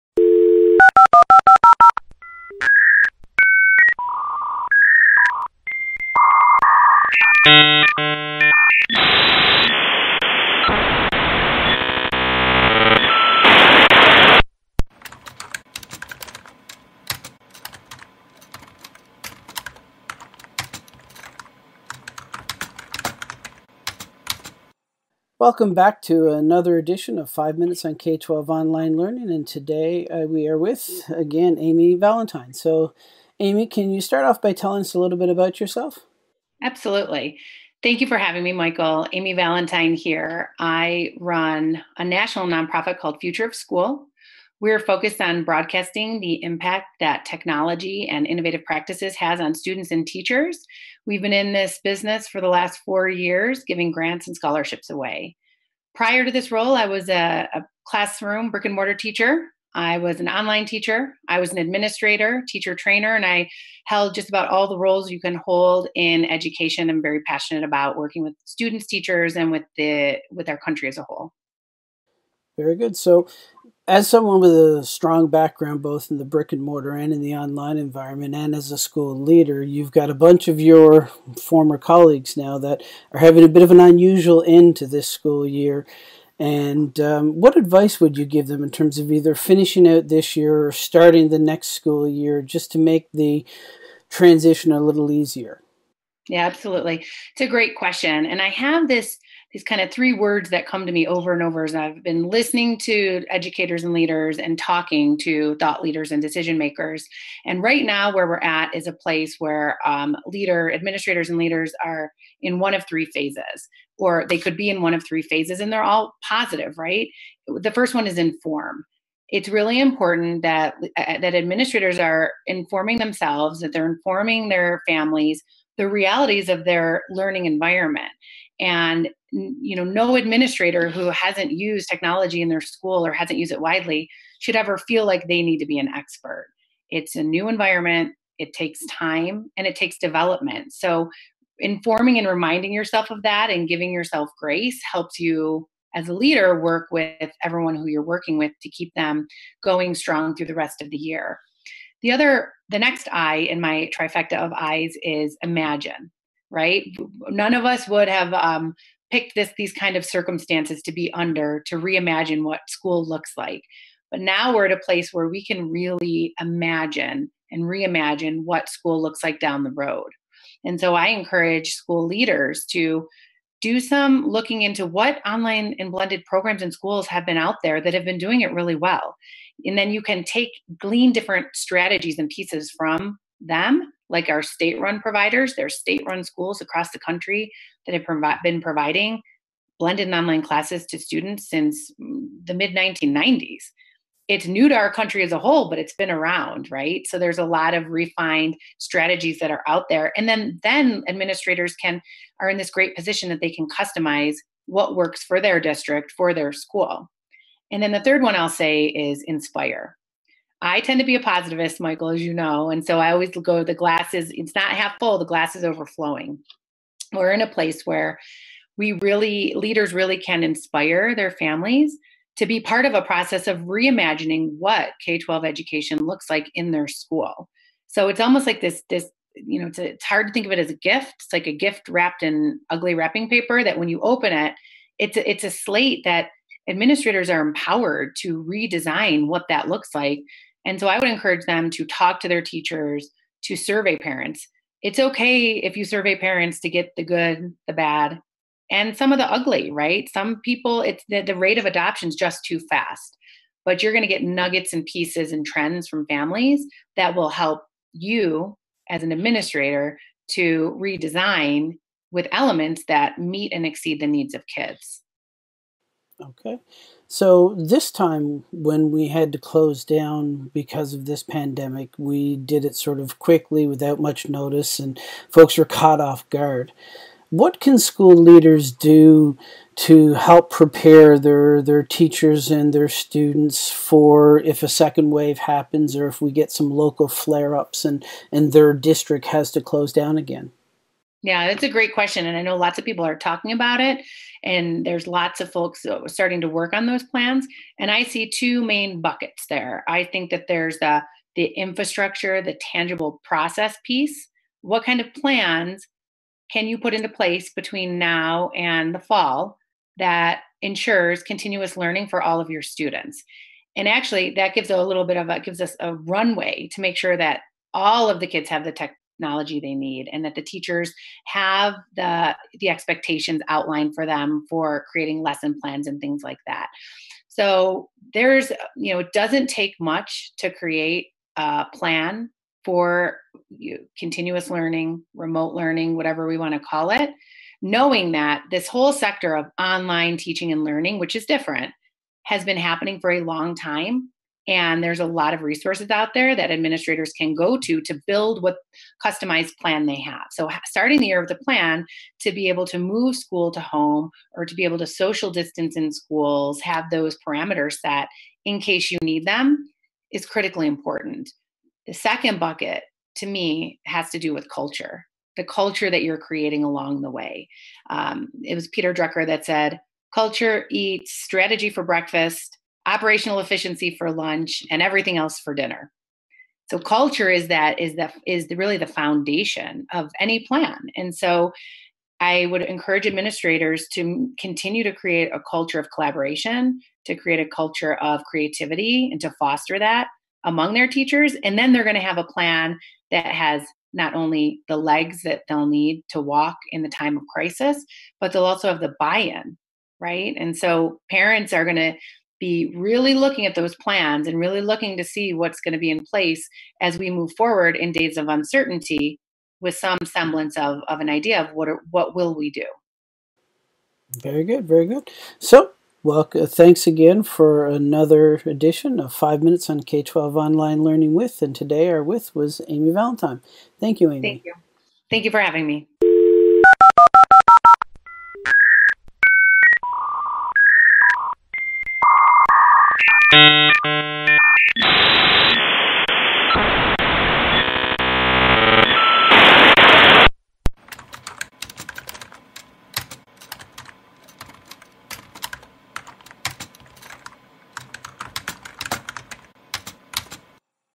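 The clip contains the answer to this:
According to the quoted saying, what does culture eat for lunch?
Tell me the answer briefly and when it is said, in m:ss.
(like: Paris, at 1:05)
operational efficiency, at 6:12.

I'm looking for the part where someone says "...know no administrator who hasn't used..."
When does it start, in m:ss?
2:09.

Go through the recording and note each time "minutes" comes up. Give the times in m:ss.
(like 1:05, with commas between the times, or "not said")
0:27, 6:59.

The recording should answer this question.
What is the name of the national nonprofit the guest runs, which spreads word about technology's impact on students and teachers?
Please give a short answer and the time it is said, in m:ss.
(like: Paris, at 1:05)
Future of School, at 0:43.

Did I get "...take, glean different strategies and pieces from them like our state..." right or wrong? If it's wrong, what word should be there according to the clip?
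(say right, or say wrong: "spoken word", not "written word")
right.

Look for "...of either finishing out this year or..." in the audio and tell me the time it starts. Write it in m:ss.
1:28.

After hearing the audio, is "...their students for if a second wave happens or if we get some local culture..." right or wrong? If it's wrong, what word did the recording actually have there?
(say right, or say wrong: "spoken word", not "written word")
wrong: "flare", not "culture".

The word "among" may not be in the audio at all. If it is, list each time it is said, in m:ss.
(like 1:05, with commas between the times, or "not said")
6:30.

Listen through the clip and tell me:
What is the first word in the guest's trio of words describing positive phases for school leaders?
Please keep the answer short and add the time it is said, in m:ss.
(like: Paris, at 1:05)
Inform, at 1:58.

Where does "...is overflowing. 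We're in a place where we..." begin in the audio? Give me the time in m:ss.
3:35.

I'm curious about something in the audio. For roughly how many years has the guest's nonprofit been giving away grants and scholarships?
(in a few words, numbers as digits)
4.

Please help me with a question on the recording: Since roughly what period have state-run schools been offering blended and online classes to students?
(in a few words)
mid 1990s.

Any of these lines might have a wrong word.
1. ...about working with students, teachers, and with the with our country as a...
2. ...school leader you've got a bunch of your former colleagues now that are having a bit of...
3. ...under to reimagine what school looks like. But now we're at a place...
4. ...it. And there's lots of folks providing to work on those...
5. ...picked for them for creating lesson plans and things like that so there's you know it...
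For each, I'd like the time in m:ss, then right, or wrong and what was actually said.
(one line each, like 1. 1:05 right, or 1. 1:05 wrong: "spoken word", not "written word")
1. 1:07 right
2. 1:18 right
3. 2:41 right
4. 4:53 wrong: "starting", not "providing"
5. 5:23 wrong: "outlined", not "picked".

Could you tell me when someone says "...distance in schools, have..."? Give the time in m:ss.
5:55.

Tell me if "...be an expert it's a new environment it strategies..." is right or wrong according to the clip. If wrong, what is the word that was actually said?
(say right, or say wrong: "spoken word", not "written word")
wrong: "takes", not "strategies".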